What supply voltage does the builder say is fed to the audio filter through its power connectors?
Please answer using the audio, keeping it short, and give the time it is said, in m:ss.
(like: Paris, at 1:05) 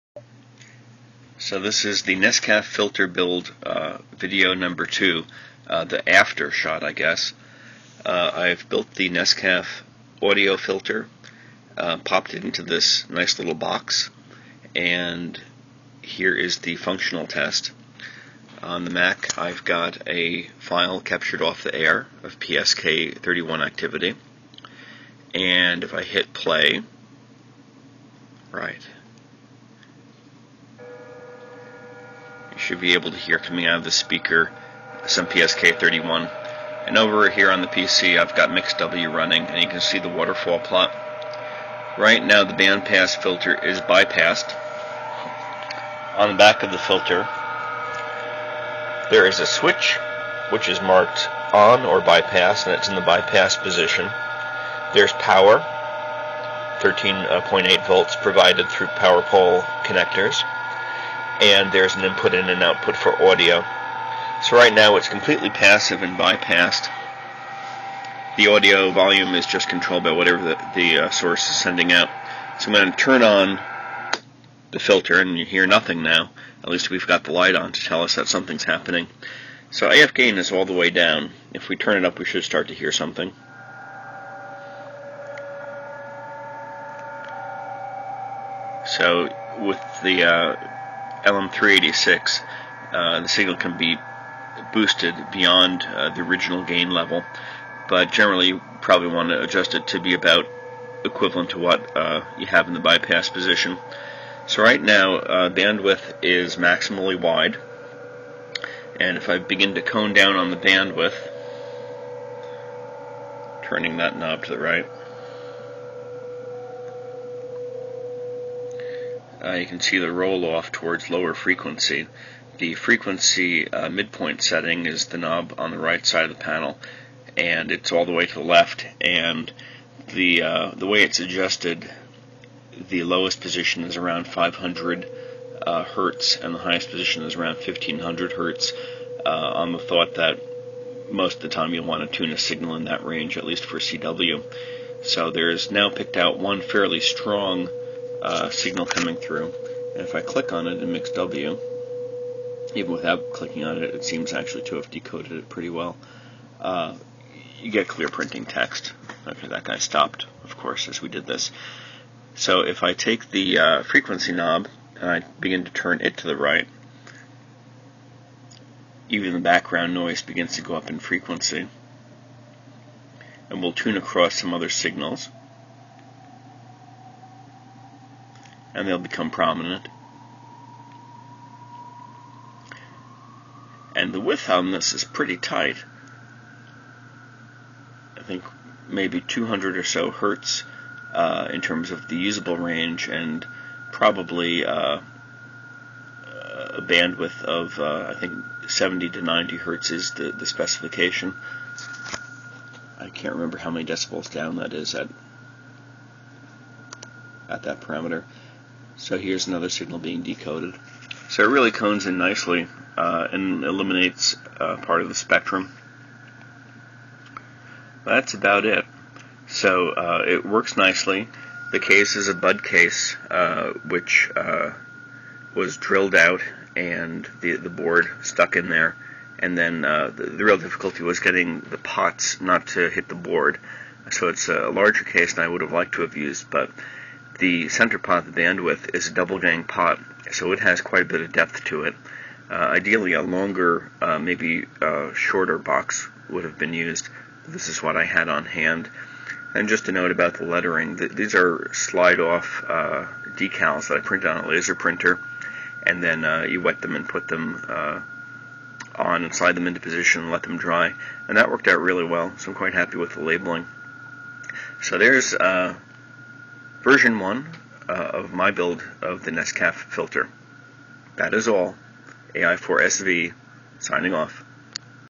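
13.8 volts, at 0:56.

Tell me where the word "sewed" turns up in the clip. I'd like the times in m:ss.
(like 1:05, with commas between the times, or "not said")
not said.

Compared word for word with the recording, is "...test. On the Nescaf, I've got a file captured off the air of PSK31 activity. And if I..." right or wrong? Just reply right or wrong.
wrong.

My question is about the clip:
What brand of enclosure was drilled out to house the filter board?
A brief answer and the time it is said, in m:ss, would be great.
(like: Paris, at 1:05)
Bud, at 3:42.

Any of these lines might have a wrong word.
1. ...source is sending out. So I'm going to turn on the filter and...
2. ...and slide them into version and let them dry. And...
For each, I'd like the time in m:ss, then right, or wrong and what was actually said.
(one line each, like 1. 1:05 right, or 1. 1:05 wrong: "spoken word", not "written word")
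1. 1:11 right
2. 4:19 wrong: "position", not "version".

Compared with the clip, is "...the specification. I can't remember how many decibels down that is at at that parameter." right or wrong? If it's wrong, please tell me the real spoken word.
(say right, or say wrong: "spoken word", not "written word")
right.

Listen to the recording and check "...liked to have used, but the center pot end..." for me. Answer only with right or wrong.
right.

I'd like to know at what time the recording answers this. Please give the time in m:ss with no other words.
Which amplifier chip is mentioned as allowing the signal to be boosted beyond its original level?
1:31.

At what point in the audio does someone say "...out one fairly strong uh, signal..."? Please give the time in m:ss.
2:26.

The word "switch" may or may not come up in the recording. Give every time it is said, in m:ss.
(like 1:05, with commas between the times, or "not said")
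0:49.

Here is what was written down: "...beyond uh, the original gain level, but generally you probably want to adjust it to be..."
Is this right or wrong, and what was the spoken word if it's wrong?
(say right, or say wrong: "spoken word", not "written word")
right.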